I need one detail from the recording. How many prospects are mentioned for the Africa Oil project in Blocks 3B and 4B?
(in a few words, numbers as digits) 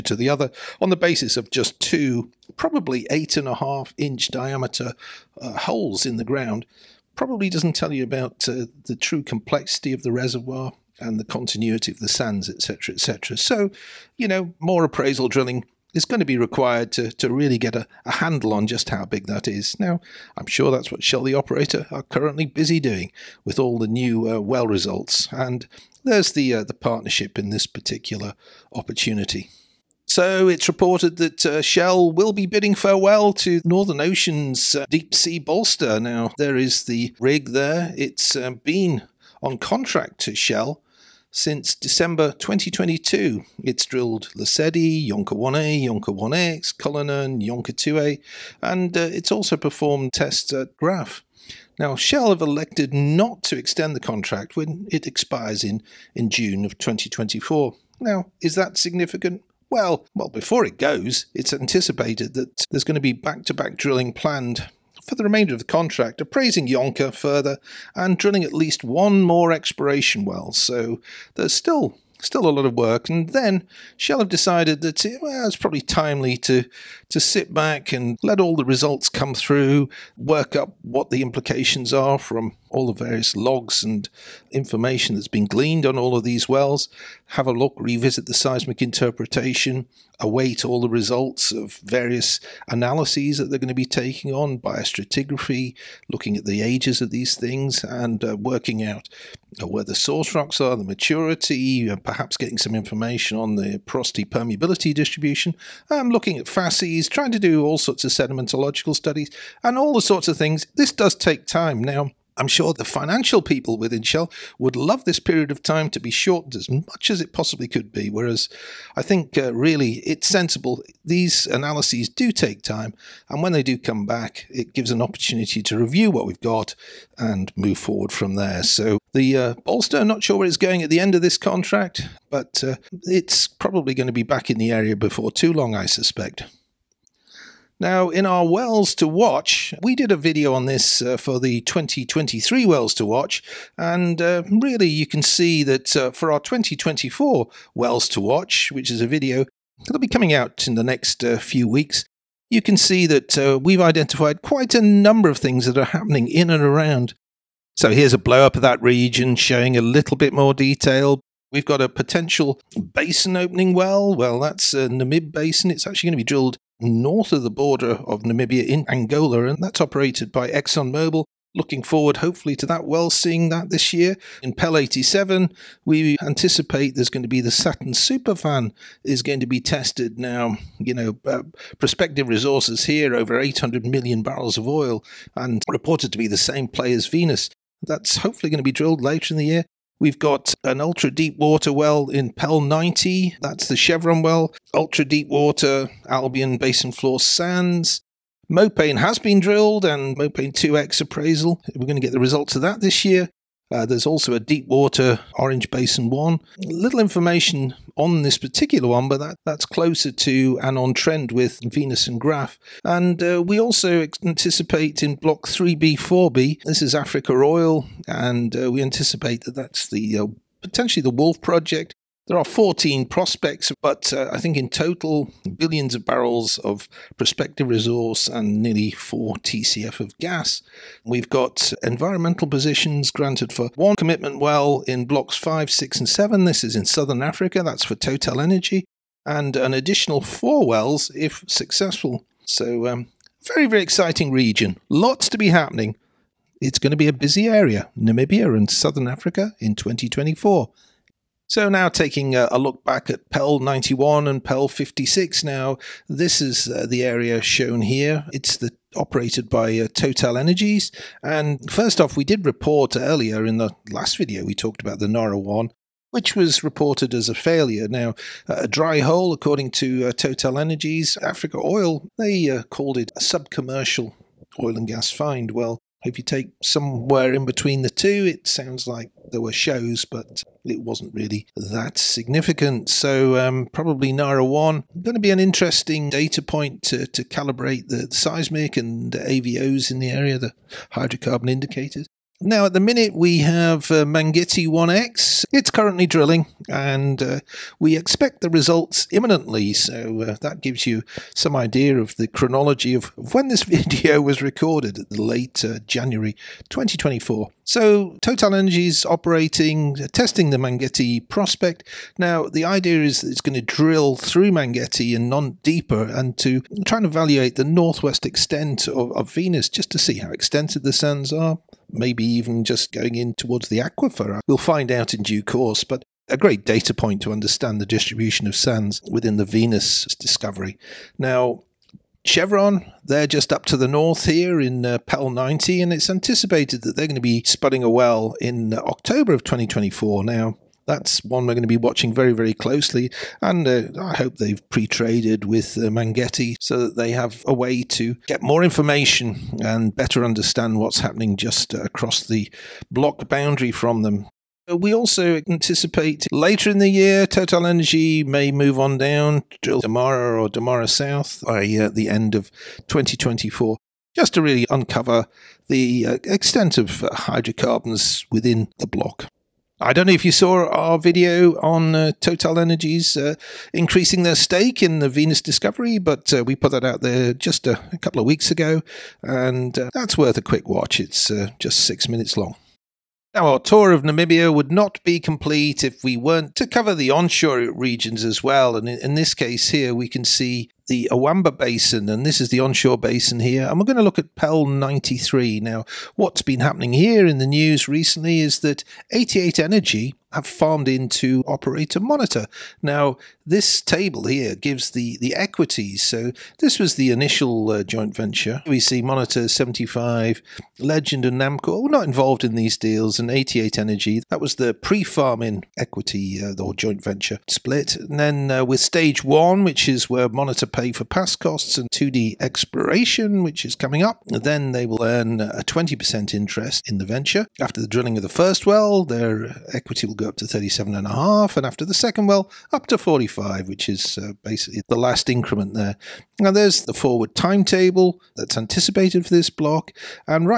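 14.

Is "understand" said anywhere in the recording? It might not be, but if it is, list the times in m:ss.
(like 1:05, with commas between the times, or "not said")
5:27, 5:50.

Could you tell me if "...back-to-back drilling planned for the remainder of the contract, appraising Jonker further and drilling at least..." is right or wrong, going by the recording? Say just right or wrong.
right.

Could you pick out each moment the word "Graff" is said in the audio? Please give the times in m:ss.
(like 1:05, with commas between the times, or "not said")
0:50, 3:32.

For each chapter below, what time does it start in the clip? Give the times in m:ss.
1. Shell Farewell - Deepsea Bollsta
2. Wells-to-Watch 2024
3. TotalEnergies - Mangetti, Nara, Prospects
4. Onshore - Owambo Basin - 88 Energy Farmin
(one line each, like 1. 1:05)
1. 0:29
2. 2:17
3. 4:11
4. 6:23.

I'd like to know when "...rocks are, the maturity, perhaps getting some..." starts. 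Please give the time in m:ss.
1:40.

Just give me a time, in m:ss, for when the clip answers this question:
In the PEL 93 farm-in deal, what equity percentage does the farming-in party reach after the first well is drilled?
7:10.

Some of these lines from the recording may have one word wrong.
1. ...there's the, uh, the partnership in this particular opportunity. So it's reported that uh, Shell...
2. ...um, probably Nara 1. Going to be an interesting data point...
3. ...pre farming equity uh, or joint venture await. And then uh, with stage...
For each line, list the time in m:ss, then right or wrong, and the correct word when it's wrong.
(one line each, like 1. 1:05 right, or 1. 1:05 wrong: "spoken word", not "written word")
1. 0:26 right
2. 4:43 right
3. 6:54 wrong: "split", not "await".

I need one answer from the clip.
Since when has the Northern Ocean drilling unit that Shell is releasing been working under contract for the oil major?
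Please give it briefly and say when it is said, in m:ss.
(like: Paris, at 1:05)
December 2022, at 0:41.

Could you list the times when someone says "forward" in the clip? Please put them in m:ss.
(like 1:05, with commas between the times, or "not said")
2:07, 2:51, 7:16.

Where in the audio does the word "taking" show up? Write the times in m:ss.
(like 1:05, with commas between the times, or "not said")
1:33, 4:11.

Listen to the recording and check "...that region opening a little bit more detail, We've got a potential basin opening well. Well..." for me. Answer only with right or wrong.
wrong.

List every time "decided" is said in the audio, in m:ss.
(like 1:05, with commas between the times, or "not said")
1:14.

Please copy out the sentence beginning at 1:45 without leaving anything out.
I'm looking at facies, trying to do all sorts of sedimentological studies, and all the sorts of things.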